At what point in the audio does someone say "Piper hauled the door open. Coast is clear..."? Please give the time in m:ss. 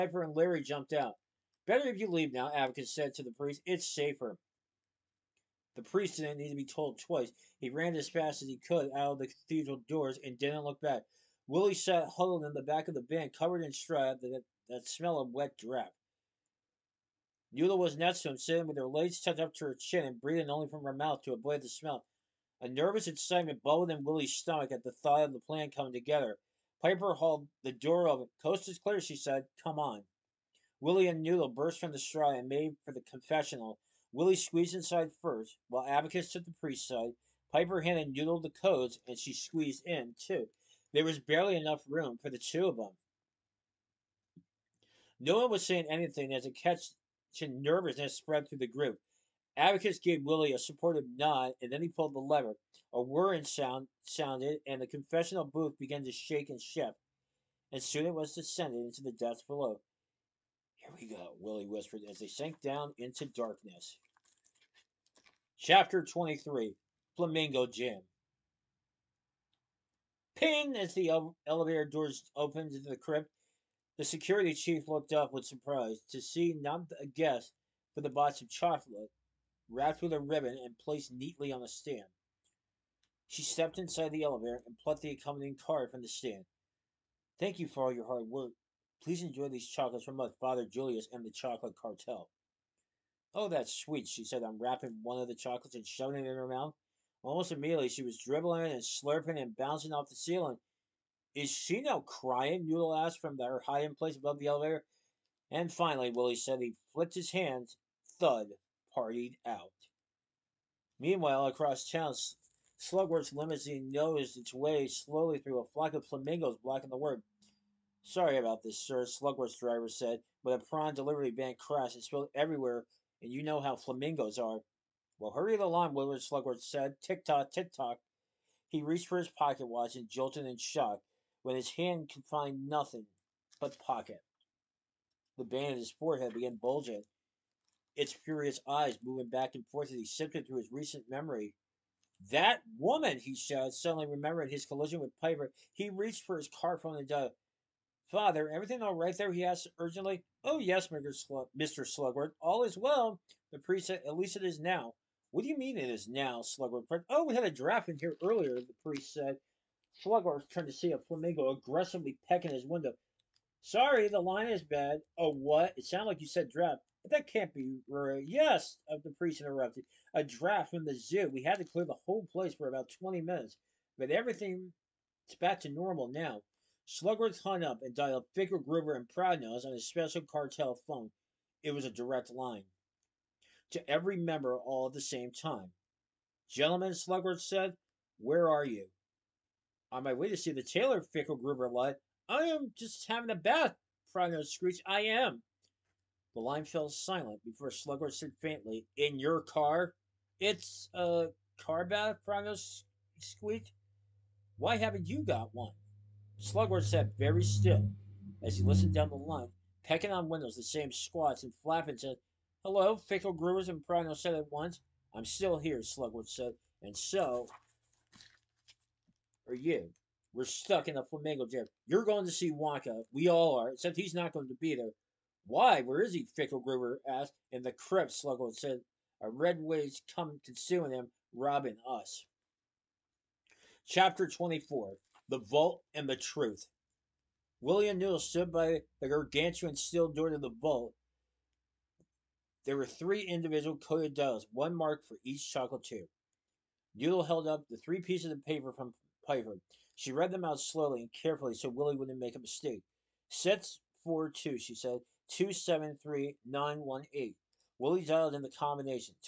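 0:26.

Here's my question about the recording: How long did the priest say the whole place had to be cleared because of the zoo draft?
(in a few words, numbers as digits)
20 minutes.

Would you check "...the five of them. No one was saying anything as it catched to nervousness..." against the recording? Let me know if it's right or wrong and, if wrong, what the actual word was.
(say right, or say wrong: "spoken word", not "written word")
wrong: "two", not "five".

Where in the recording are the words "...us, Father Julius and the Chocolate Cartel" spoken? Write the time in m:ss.
1:30.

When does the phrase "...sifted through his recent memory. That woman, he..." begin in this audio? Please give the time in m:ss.
2:20.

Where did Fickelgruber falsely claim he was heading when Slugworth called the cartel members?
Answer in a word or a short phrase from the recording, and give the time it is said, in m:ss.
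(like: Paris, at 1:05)
The tailor, at 3:10.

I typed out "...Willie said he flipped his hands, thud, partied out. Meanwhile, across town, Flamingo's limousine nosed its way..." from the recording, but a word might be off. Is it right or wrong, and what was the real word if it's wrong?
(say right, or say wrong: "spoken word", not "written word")
wrong: "Slugworth", not "Flamingo".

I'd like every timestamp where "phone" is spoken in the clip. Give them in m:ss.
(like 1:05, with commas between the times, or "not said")
2:26, 3:00.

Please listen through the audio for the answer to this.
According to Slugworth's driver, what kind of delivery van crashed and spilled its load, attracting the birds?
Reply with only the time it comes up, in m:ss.
2:00.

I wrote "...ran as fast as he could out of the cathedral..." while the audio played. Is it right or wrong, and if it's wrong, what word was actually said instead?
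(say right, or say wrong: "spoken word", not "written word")
right.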